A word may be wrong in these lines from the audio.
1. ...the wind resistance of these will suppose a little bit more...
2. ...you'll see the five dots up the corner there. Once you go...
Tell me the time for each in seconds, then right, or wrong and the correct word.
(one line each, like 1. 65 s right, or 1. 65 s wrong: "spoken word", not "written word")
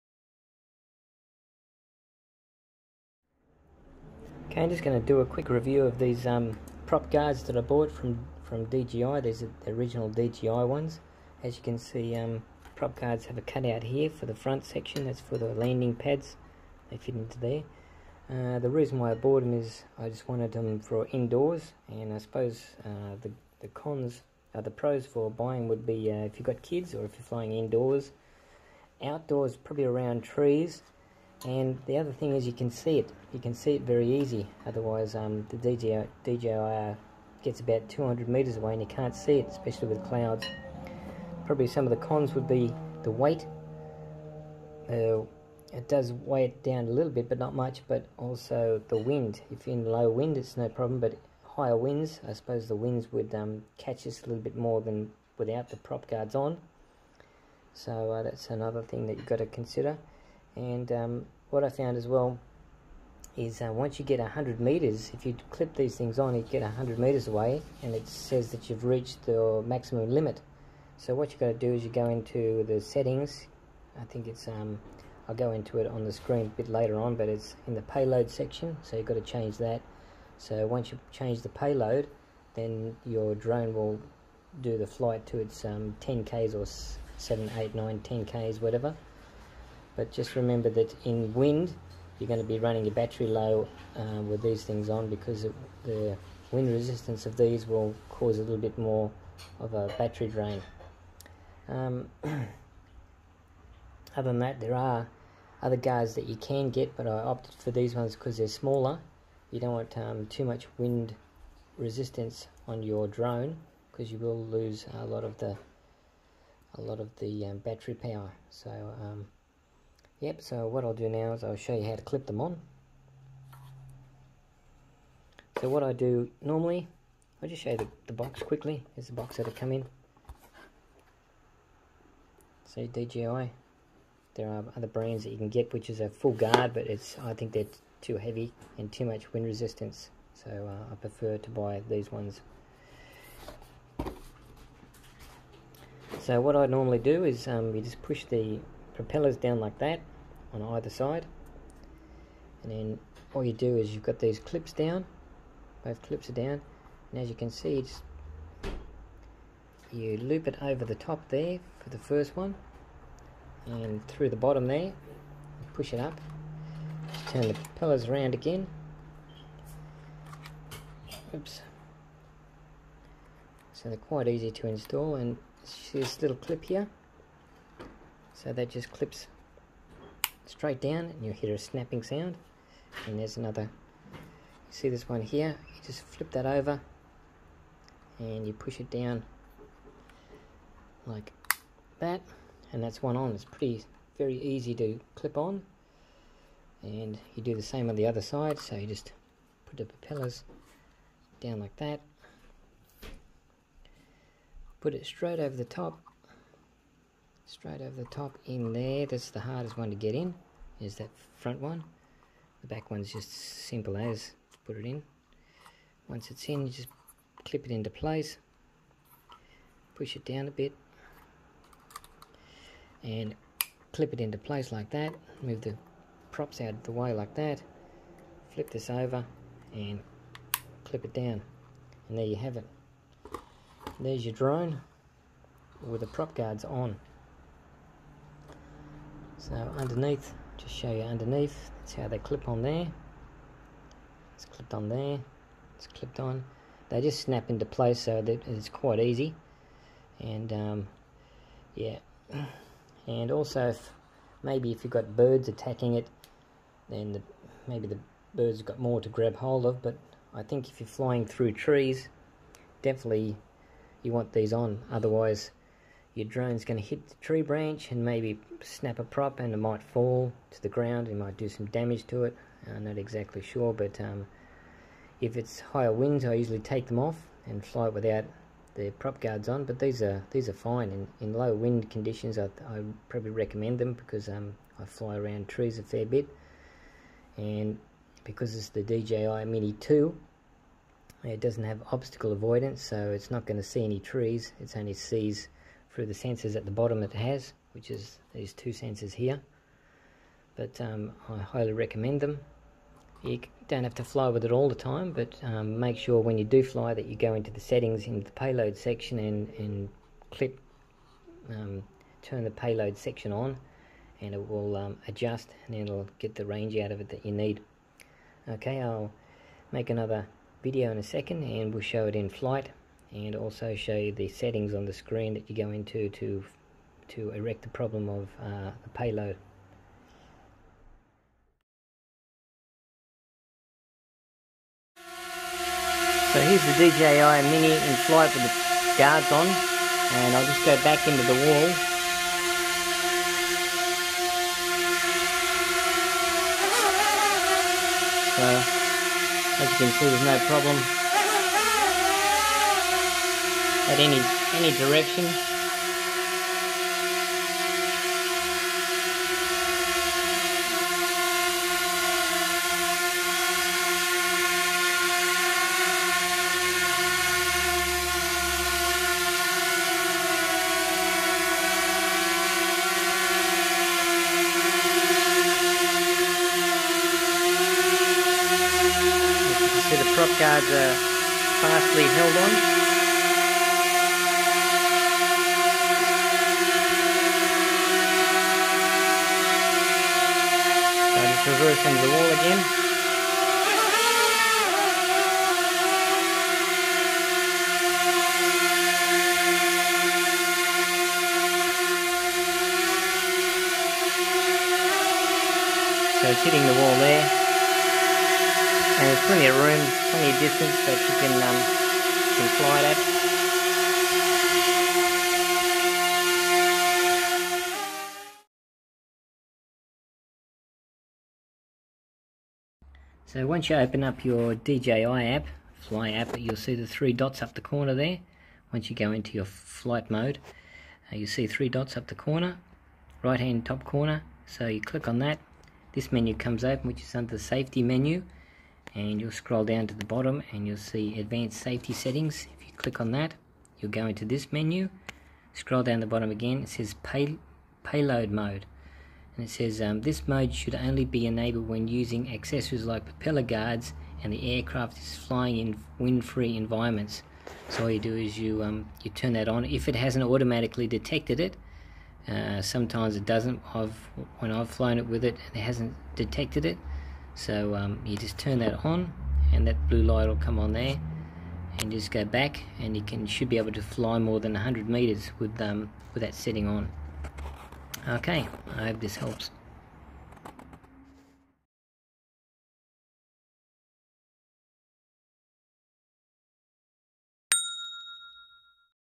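1. 95 s wrong: "cause", not "suppose"
2. 426 s wrong: "three", not "five".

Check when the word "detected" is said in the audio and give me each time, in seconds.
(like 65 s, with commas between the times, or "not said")
460 s, 466 s.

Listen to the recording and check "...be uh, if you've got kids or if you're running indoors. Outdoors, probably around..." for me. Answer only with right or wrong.
wrong.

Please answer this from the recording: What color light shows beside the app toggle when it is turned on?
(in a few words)
blue.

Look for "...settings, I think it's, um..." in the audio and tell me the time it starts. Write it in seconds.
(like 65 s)
72 s.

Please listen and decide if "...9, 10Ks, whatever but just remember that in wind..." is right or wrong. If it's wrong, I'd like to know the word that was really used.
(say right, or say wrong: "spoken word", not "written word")
right.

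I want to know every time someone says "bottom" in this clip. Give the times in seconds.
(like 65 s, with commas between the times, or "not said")
164 s, 296 s, 440 s, 446 s.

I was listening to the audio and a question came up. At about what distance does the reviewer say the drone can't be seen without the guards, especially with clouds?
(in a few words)
200 meters.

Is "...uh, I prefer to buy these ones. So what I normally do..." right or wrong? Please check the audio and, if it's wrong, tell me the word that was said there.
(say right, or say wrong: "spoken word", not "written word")
right.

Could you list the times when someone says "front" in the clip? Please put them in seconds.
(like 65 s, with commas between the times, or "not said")
14 s, 211 s.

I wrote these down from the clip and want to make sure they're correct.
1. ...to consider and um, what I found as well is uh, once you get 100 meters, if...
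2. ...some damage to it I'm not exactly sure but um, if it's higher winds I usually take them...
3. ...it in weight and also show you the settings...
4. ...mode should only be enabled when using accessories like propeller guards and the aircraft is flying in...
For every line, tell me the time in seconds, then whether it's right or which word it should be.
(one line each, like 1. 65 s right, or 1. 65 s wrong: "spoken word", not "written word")
1. 59 s right
2. 271 s right
3. 322 s wrong: "flight", not "weight"
4. 450 s right.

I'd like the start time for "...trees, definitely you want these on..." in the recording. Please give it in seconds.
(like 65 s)
261 s.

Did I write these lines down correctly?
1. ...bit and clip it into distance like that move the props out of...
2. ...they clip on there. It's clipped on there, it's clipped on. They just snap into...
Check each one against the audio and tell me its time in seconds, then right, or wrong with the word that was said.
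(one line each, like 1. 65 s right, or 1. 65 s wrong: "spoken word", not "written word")
1. 220 s wrong: "place", not "distance"
2. 242 s right.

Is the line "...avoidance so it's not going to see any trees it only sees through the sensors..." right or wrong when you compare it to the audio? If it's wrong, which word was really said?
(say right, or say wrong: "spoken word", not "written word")
right.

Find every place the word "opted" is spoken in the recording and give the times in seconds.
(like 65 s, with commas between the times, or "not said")
107 s.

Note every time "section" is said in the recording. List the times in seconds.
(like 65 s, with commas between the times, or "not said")
14 s, 78 s, 308 s, 312 s.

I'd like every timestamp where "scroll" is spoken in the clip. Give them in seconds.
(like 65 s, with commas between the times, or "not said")
439 s, 445 s.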